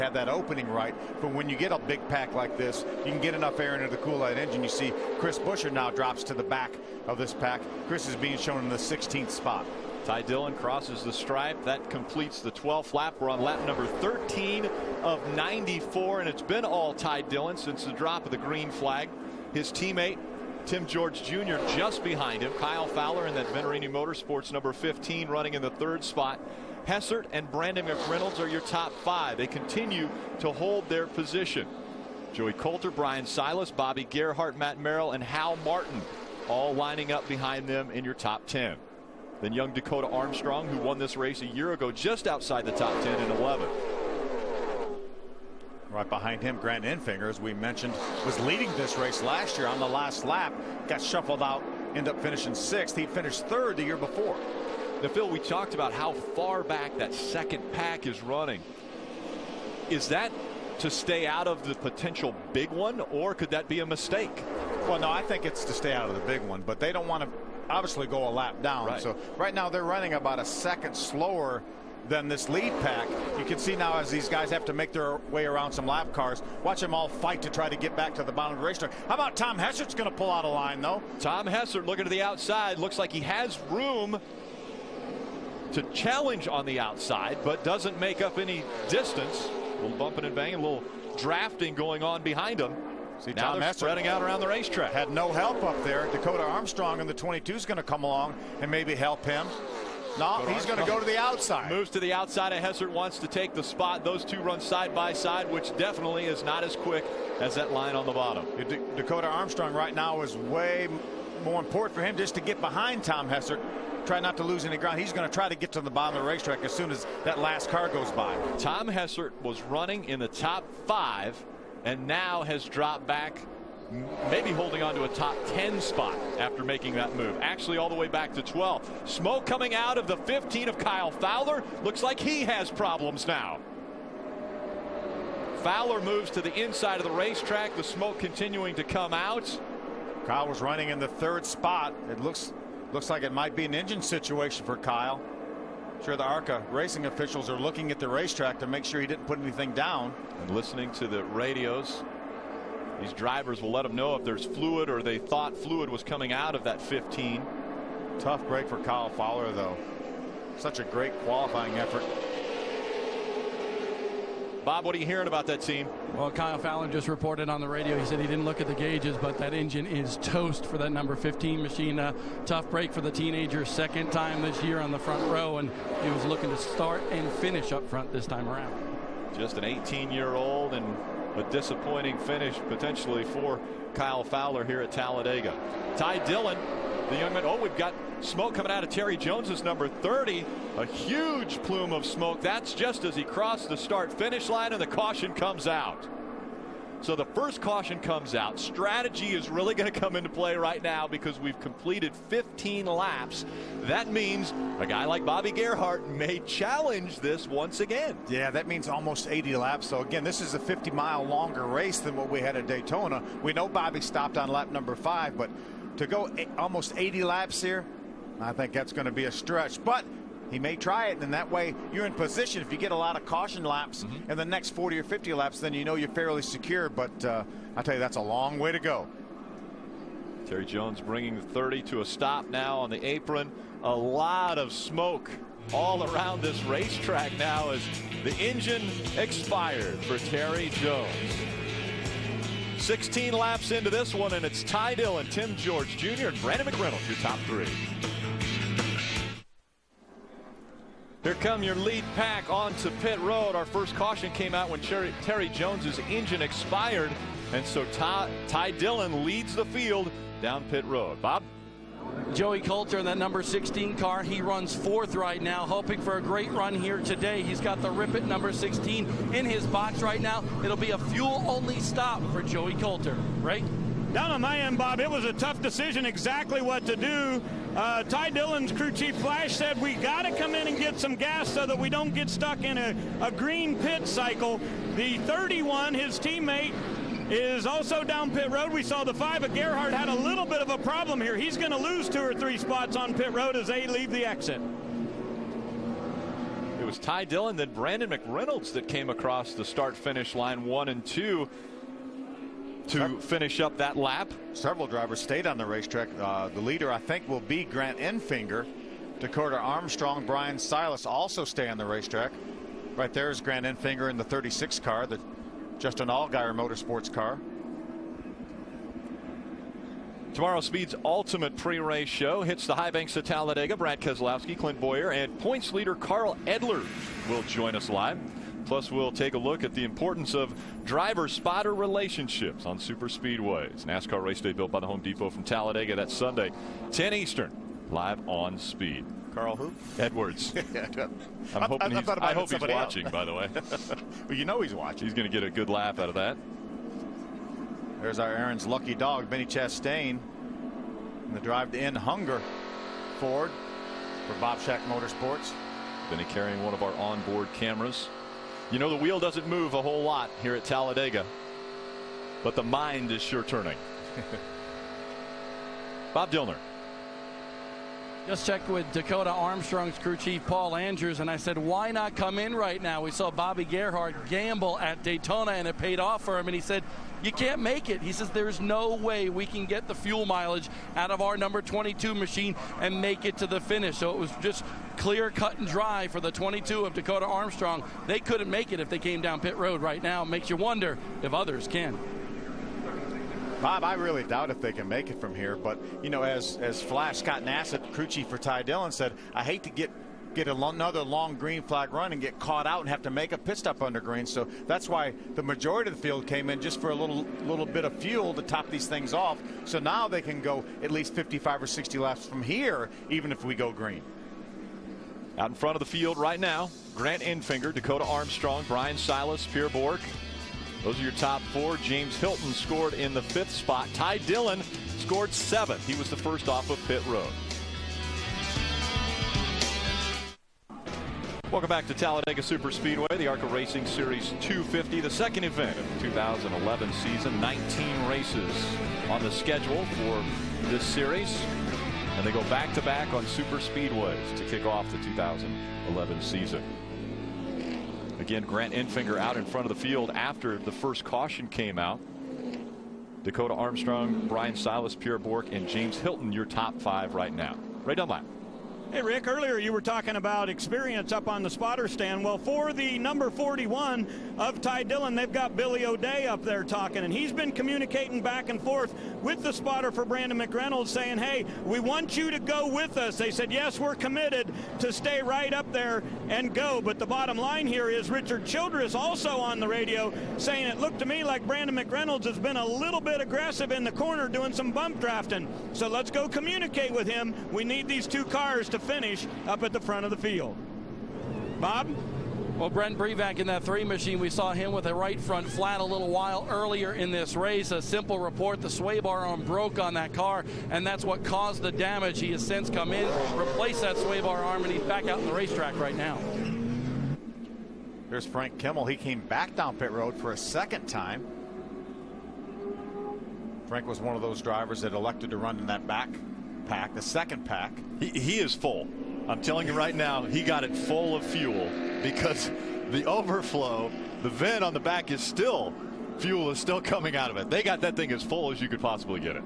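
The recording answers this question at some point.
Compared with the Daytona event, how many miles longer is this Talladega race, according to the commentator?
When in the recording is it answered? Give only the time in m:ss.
3:30.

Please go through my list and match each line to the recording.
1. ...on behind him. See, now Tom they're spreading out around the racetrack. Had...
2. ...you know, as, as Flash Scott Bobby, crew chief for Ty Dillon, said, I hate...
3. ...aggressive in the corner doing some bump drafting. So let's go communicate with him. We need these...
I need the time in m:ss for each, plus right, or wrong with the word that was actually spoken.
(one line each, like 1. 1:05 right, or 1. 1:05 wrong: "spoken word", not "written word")
1. 1:32 right
2. 6:36 wrong: "Nassett", not "Bobby"
3. 8:03 right.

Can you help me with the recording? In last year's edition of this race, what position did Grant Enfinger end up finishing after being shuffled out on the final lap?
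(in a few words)
sixth.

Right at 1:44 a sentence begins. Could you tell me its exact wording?
Those two run side by side, which definitely is not as quick as that line on the bottom.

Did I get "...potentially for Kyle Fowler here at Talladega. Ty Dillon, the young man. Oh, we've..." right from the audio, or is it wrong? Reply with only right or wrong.
right.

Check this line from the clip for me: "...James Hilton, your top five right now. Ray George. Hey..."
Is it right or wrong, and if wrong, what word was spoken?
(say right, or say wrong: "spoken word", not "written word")
wrong: "Dunlap", not "George".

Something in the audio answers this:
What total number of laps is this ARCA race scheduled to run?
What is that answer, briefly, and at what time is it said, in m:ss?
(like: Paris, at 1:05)
94, at 0:13.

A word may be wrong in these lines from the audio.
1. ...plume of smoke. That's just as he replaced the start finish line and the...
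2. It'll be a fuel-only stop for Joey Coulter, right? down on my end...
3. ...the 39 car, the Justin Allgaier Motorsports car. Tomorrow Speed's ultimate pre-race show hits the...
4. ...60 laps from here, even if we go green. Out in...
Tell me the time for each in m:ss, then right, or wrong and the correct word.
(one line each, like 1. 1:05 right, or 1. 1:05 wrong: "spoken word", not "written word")
1. 3:11 wrong: "crossed", not "replaced"
2. 4:30 right
3. 5:14 wrong: "36", not "39"
4. 6:51 right.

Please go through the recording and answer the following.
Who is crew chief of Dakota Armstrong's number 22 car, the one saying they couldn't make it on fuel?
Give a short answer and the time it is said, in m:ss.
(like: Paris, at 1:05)
Paul Andrews, at 6:10.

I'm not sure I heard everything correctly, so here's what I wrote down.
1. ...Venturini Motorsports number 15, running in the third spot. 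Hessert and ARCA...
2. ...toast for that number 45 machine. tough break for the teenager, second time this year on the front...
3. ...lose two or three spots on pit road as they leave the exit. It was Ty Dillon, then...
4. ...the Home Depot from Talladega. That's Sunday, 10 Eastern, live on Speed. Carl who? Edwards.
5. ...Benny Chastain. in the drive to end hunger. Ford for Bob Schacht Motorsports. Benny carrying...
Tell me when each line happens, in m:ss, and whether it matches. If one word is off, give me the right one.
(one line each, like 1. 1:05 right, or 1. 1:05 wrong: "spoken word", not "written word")
1. 0:23 wrong: "Brandon", not "ARCA"
2. 2:50 wrong: "15", not "45"
3. 4:51 right
4. 5:34 right
5. 5:49 right.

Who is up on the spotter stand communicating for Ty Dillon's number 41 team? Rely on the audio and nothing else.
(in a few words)
Billy O'Day.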